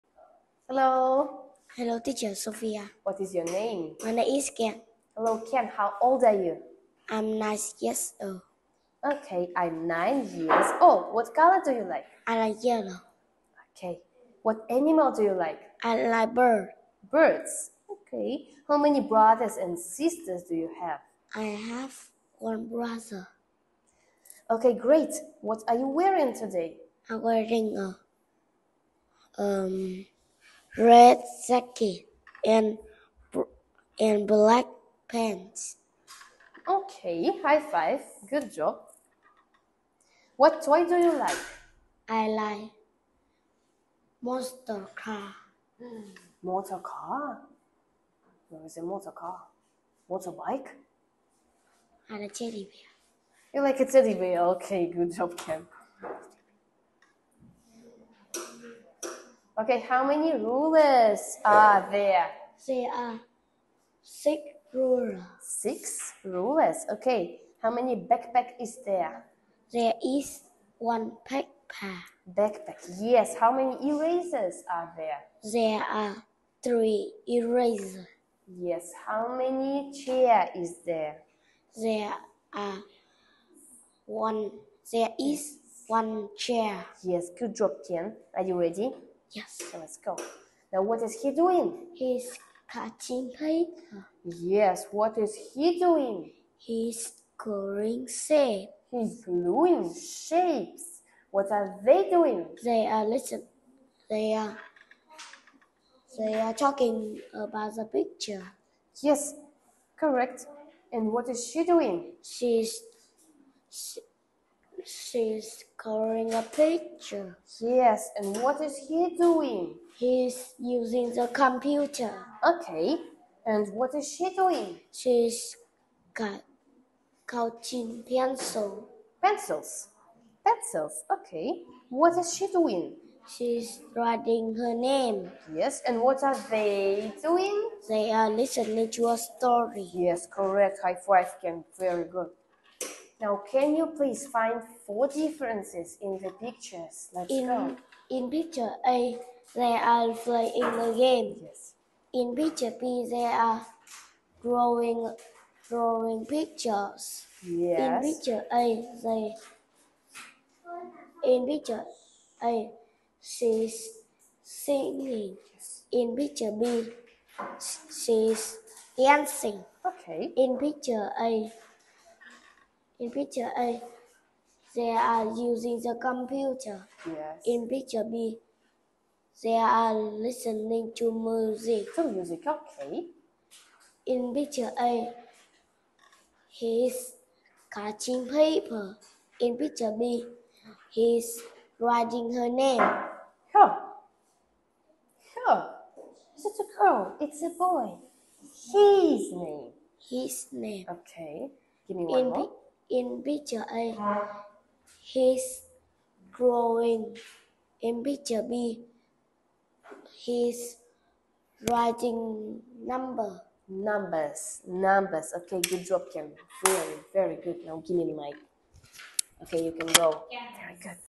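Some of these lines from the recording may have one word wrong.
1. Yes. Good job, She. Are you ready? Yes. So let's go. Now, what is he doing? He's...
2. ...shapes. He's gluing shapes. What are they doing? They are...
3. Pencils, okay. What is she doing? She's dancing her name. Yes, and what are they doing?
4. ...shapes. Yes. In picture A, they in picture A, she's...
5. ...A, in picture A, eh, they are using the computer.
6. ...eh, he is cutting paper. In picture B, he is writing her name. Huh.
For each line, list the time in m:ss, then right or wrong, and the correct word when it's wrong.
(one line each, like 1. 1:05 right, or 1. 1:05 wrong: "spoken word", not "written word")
1. 1:27 wrong: "Tian", not "She"
2. 1:38 right
3. 2:10 wrong: "writing", not "dancing"
4. 2:36 wrong: "pictures", not "shapes"
5. 2:51 right
6. 3:04 right.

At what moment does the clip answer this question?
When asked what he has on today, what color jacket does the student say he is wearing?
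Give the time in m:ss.
0:30.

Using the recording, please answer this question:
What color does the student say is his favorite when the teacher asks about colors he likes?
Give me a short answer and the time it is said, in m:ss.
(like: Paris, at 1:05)
yellow, at 0:12.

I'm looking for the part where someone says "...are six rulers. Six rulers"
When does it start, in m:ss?
1:02.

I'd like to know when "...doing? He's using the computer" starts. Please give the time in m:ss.
1:59.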